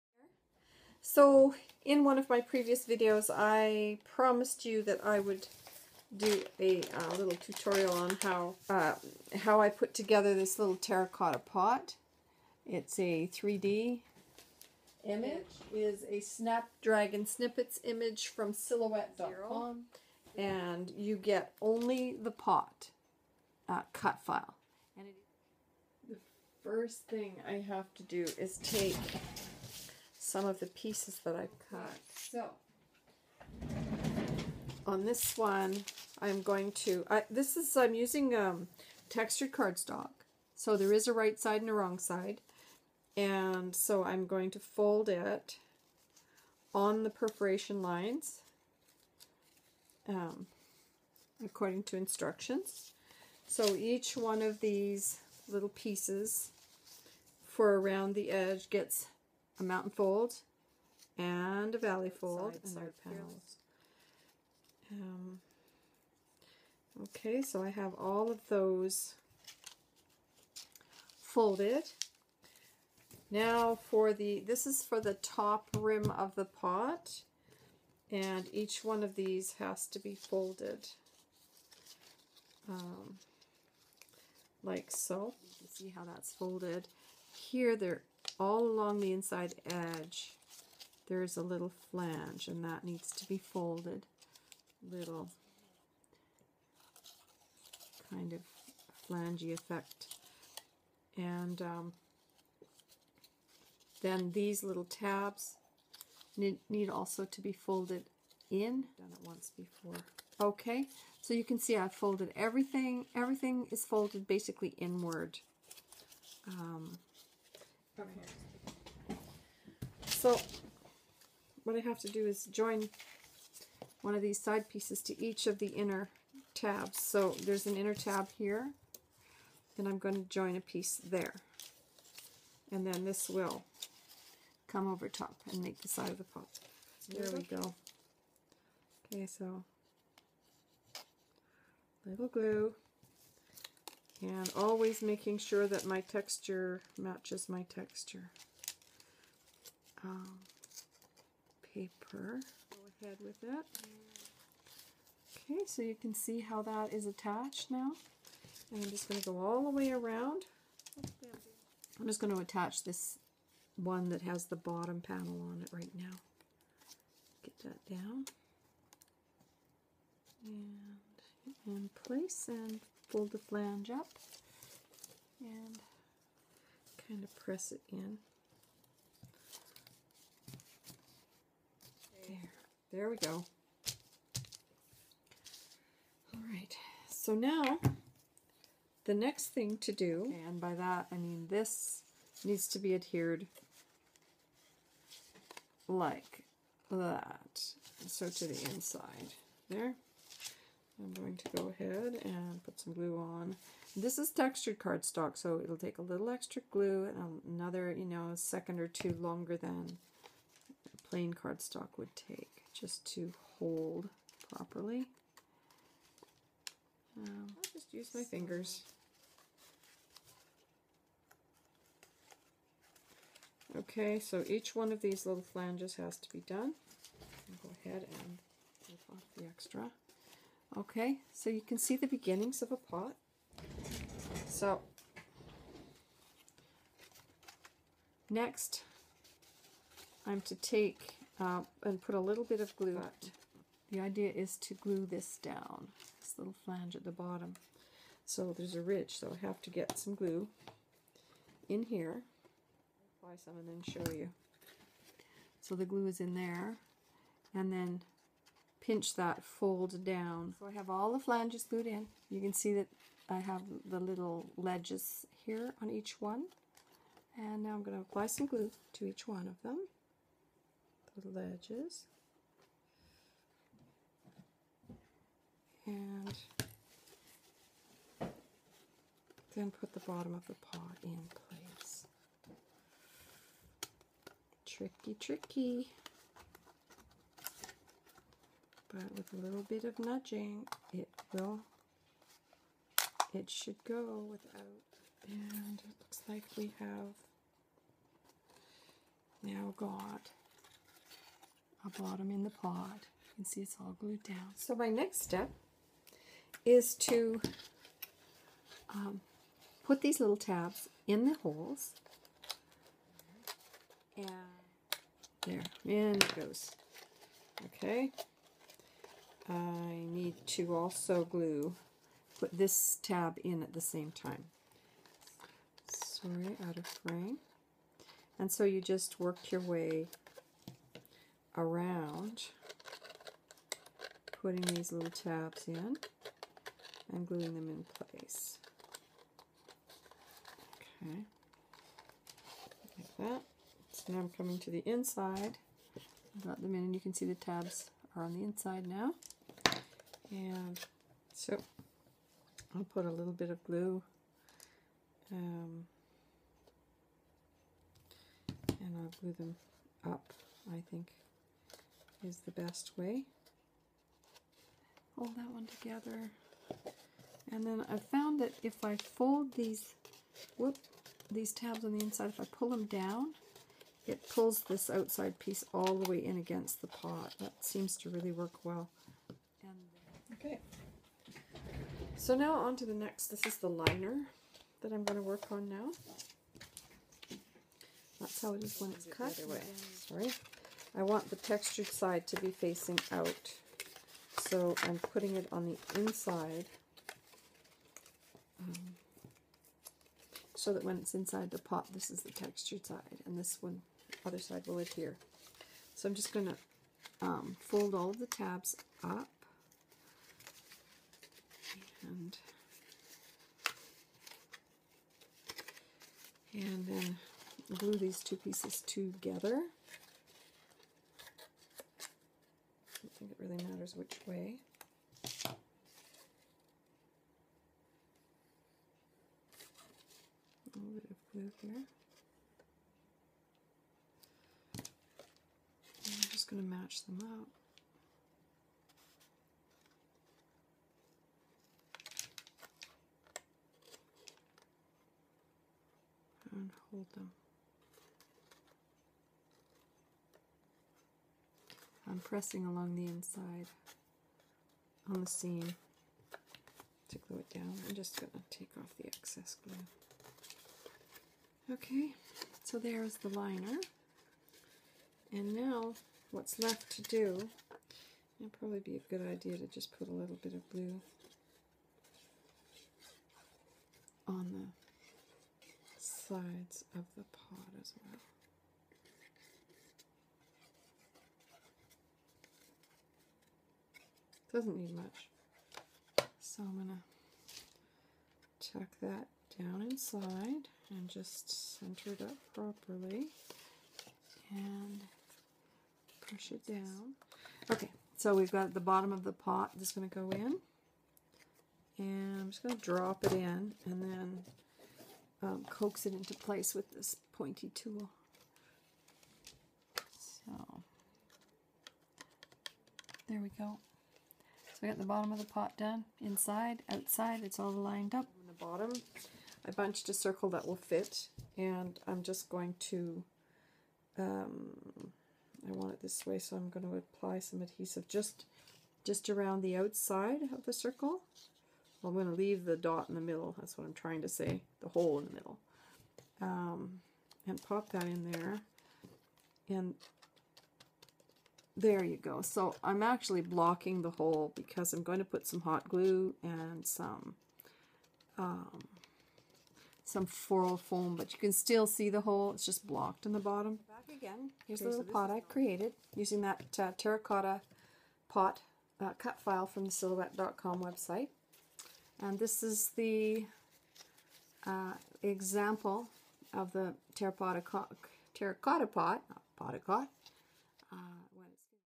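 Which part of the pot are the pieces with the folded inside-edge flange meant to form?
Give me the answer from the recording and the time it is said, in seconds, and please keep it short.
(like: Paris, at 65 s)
top rim, at 75 s.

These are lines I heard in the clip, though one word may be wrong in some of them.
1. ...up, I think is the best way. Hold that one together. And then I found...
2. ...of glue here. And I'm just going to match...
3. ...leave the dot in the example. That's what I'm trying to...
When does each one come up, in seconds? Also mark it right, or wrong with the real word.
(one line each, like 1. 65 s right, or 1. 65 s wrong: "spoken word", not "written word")
1. 360 s right
2. 431 s right
3. 532 s wrong: "middle", not "example".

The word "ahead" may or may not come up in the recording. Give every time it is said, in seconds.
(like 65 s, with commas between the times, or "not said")
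153 s, 201 s, 227 s.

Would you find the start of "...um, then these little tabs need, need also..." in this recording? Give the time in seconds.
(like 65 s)
101 s.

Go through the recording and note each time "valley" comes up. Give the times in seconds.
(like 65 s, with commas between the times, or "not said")
61 s.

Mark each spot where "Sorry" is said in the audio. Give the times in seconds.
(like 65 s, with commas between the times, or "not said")
325 s, 389 s.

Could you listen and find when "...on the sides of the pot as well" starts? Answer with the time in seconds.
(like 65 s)
474 s.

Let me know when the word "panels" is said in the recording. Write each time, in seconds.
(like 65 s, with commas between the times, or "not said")
63 s, 165 s.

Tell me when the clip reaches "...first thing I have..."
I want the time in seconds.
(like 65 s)
26 s.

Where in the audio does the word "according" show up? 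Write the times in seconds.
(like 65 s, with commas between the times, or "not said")
51 s.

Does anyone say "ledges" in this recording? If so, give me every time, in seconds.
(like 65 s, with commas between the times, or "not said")
264 s, 271 s.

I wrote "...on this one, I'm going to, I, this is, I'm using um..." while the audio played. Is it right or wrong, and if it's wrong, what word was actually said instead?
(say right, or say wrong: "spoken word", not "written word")
right.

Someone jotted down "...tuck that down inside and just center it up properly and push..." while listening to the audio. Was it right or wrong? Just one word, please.
right.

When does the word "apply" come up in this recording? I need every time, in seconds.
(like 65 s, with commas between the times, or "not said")
253 s, 268 s, 526 s.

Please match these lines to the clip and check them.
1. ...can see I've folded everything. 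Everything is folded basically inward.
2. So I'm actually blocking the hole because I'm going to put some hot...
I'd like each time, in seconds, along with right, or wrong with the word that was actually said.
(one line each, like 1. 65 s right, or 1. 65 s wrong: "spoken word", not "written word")
1. 111 s right
2. 542 s right.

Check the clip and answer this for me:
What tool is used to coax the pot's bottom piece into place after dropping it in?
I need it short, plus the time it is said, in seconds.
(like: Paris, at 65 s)
pointy tool, at 507 s.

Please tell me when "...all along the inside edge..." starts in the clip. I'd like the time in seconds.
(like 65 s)
88 s.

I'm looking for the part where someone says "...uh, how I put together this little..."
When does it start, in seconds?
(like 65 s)
8 s.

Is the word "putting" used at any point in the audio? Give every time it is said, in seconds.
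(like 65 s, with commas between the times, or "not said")
334 s, 394 s.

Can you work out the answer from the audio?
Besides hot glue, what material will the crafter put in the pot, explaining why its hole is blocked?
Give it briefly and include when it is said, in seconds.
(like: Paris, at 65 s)
floral foam, at 550 s.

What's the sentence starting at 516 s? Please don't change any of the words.
Inside, outside, it's all lined up.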